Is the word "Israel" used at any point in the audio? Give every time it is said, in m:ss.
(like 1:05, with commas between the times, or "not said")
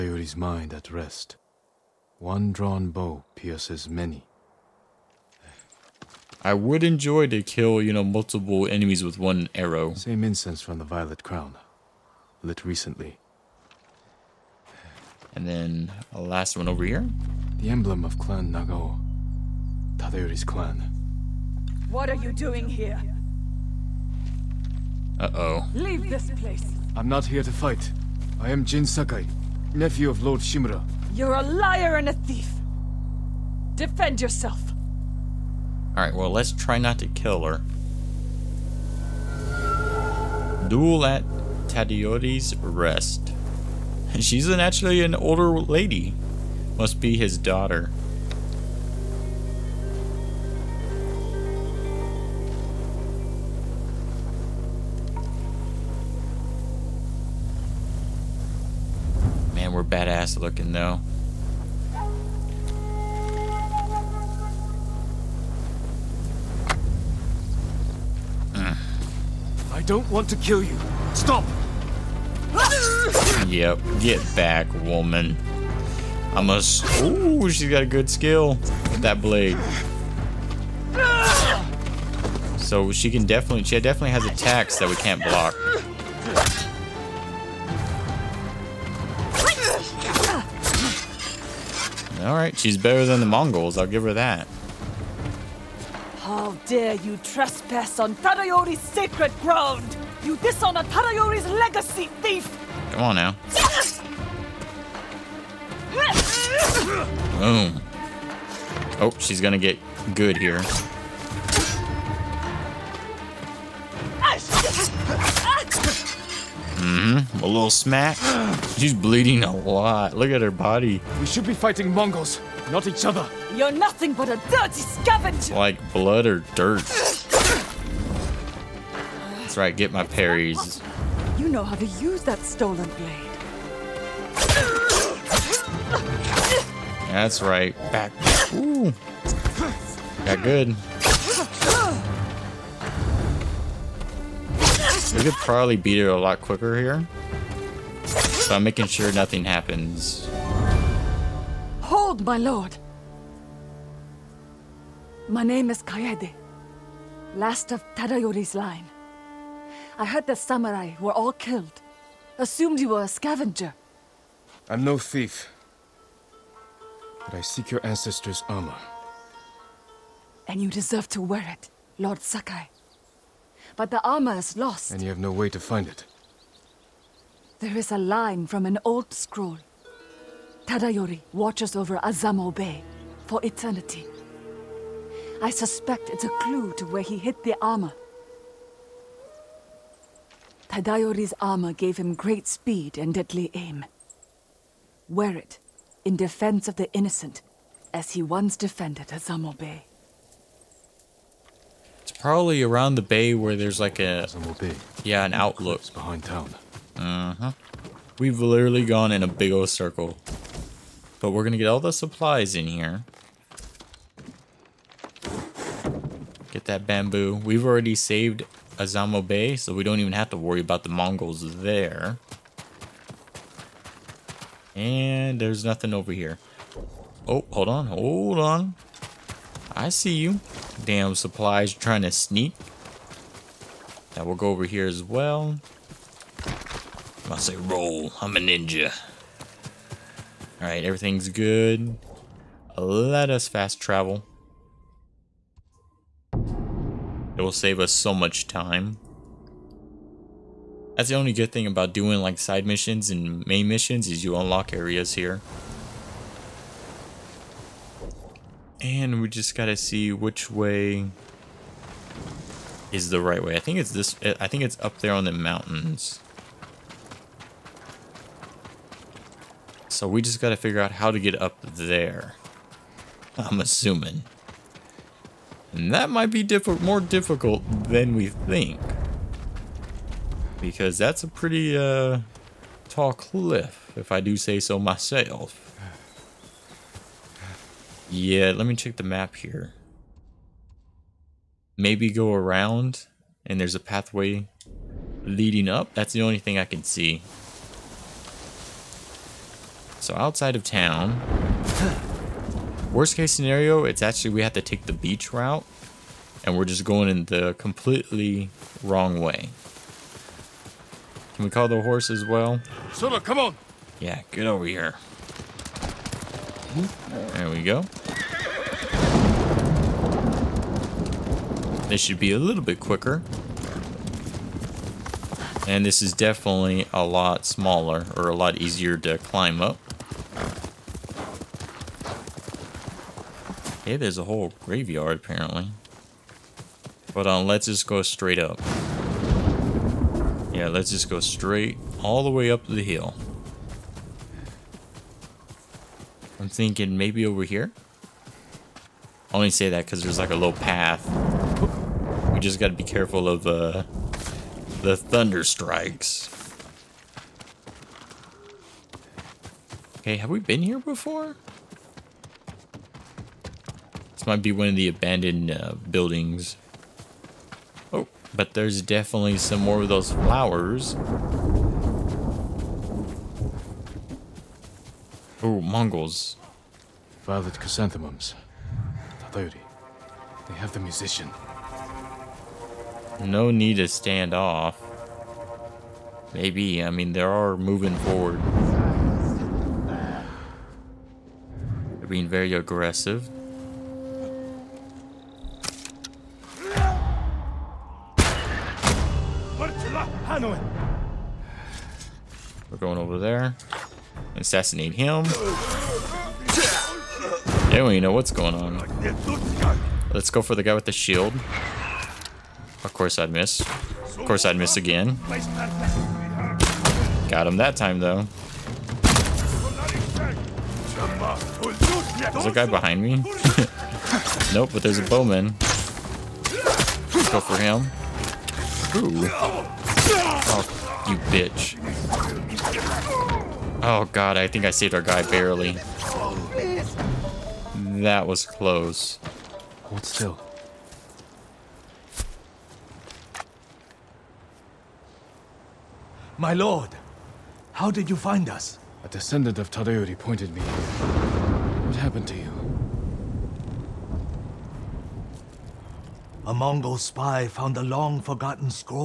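not said.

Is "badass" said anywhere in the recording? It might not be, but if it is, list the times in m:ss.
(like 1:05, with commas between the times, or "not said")
0:59.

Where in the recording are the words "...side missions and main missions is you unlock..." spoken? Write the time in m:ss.
4:12.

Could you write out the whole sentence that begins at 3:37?
We've already saved Azamo Bay, so we don't even have to worry about the Mongols there.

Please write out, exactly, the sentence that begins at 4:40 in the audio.
Because that's a pretty uh, tall cliff, if I do say so myself.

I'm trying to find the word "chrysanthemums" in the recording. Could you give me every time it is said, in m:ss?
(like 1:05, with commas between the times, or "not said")
6:17.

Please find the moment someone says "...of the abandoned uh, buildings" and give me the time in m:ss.
6:04.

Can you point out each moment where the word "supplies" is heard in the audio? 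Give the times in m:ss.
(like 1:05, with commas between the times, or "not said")
3:31, 3:51.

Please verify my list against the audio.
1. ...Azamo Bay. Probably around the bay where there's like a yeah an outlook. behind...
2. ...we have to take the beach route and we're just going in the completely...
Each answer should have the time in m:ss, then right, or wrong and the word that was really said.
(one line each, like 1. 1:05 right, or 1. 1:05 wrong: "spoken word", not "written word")
1. 3:19 right
2. 5:04 right.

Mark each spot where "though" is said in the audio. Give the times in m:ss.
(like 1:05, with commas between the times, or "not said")
1:00, 6:58.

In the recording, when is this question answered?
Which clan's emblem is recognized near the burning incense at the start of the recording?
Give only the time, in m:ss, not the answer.
0:18.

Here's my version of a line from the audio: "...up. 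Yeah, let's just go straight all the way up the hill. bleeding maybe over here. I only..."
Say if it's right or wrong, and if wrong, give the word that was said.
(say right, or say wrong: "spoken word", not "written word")
wrong: "thinking", not "bleeding".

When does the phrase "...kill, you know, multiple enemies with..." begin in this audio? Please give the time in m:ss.
0:07.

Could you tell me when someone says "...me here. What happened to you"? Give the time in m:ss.
7:30.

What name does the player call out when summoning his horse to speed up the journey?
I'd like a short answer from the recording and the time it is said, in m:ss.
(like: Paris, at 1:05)
Sula, at 5:12.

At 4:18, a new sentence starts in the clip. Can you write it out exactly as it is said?
And we just gotta see which way is the right way.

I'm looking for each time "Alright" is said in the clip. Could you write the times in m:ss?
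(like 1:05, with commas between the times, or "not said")
0:35, 1:32, 4:00.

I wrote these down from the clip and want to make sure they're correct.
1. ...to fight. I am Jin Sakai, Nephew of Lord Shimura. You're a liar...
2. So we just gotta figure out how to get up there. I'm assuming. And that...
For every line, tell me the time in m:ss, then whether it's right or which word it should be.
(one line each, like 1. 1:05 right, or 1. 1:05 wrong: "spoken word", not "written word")
1. 0:27 right
2. 4:29 right.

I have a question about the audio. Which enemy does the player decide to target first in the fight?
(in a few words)
the guy with the shield.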